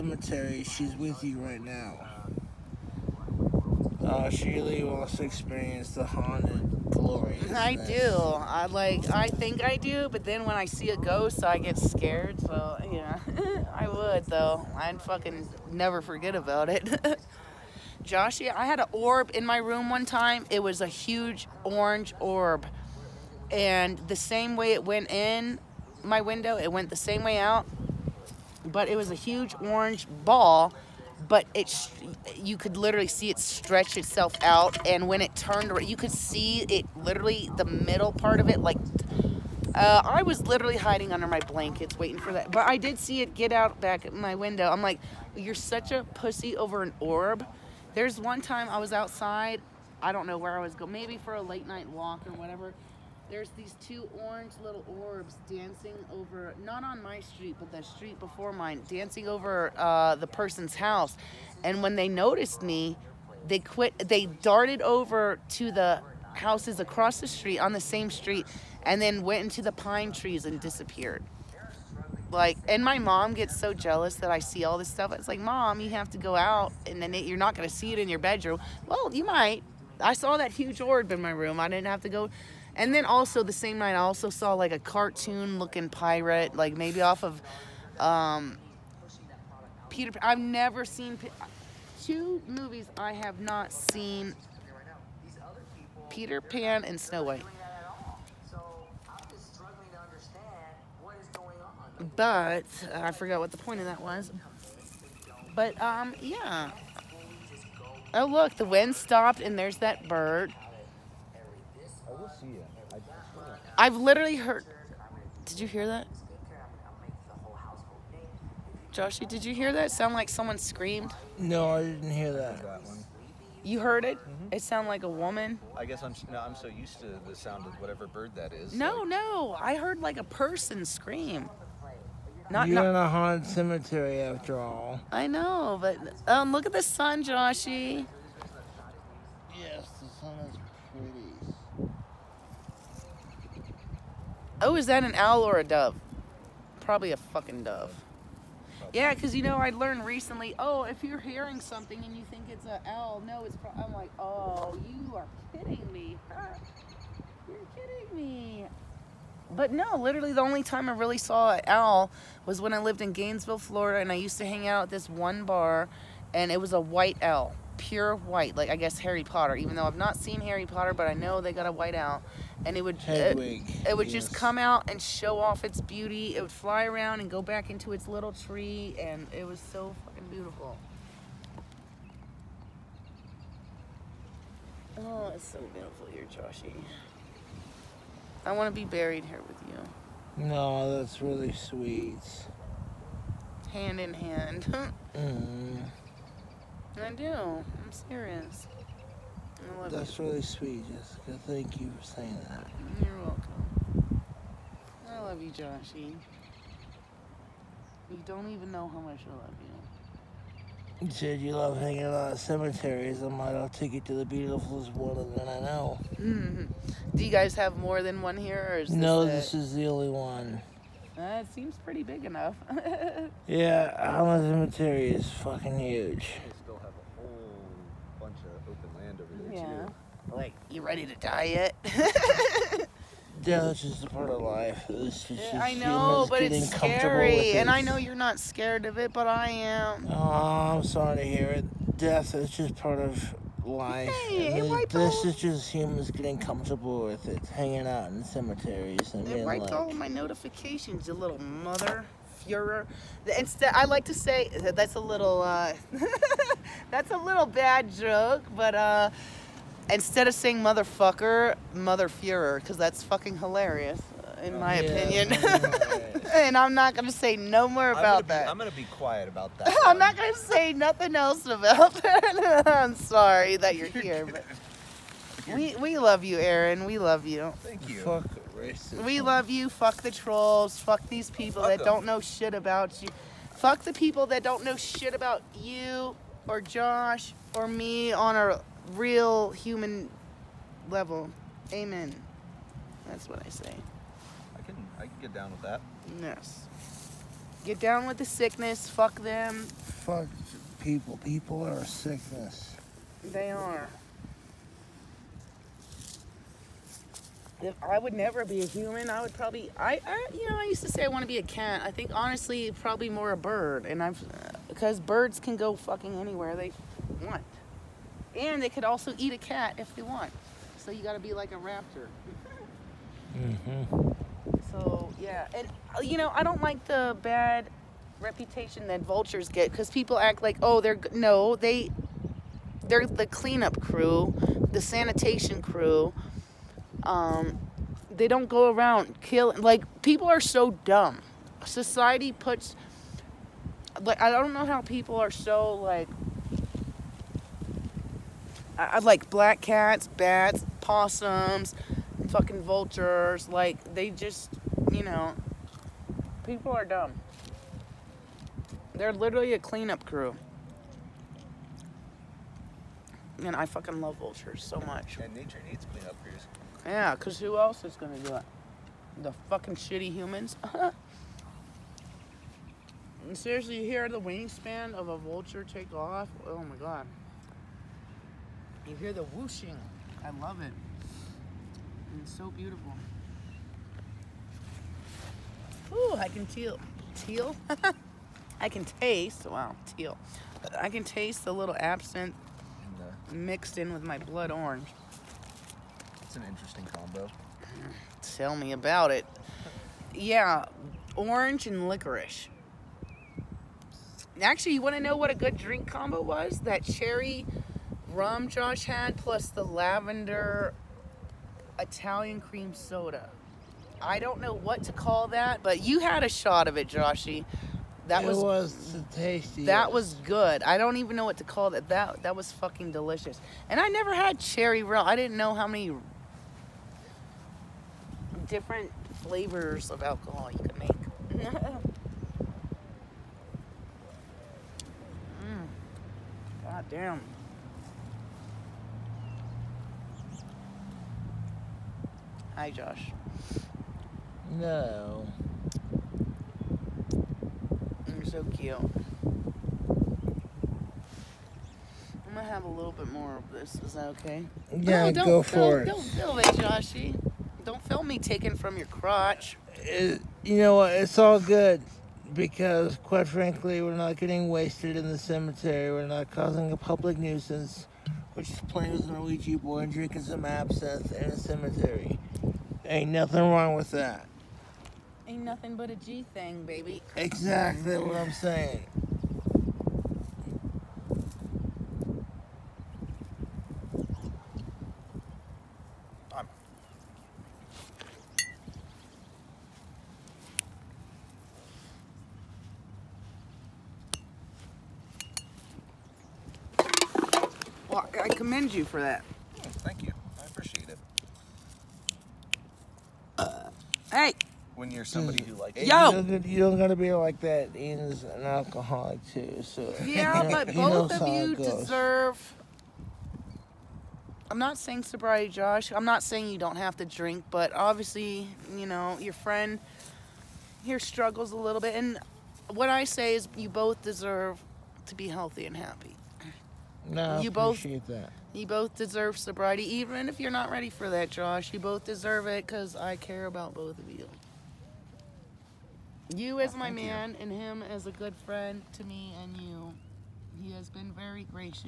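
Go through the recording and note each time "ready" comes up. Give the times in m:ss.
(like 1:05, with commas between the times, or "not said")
3:50, 8:50.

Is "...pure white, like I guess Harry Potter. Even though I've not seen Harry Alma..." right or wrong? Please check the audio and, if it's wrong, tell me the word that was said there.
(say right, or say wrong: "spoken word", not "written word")
wrong: "Potter", not "Alma".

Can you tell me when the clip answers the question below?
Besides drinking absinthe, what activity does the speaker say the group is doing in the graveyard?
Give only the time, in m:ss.
7:48.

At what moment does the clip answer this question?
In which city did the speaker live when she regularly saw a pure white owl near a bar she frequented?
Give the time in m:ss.
2:43.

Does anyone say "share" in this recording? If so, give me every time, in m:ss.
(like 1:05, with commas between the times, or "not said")
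not said.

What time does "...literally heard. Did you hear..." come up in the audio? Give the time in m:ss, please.
1:53.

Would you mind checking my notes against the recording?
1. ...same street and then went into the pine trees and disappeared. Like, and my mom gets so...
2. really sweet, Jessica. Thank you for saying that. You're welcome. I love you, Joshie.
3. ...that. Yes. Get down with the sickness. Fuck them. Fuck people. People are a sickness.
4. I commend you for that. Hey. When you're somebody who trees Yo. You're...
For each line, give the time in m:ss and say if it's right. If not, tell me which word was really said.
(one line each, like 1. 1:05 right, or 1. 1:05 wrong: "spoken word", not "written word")
1. 1:07 right
2. 3:20 right
3. 4:55 right
4. 8:18 wrong: "likes", not "trees".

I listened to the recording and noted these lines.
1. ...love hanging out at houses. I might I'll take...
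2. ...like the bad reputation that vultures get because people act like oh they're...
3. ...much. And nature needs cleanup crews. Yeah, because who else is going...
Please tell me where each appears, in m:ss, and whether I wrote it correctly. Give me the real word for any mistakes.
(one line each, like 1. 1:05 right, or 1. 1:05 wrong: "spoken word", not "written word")
1. 3:31 wrong: "cemeteries", not "houses"
2. 5:26 right
3. 6:04 right.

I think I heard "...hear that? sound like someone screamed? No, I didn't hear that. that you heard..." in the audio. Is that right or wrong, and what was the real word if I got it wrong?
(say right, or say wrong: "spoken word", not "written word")
right.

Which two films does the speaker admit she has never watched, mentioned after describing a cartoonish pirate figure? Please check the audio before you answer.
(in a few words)
Peter Pan and Snow White.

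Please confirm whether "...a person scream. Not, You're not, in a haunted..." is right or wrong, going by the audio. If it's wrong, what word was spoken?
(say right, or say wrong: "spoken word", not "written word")
right.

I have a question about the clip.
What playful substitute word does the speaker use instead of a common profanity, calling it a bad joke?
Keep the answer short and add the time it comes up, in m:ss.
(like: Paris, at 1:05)
Motherfuhrer, at 4:21.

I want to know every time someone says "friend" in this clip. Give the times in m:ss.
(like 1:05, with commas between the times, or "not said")
8:39, 8:58.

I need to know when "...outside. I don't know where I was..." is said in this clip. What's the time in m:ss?
0:48.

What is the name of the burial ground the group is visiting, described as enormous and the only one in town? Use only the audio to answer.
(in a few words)
Alma Cemetery.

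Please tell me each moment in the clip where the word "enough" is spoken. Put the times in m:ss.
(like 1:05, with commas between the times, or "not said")
3:42.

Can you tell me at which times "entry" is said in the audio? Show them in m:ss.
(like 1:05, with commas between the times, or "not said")
not said.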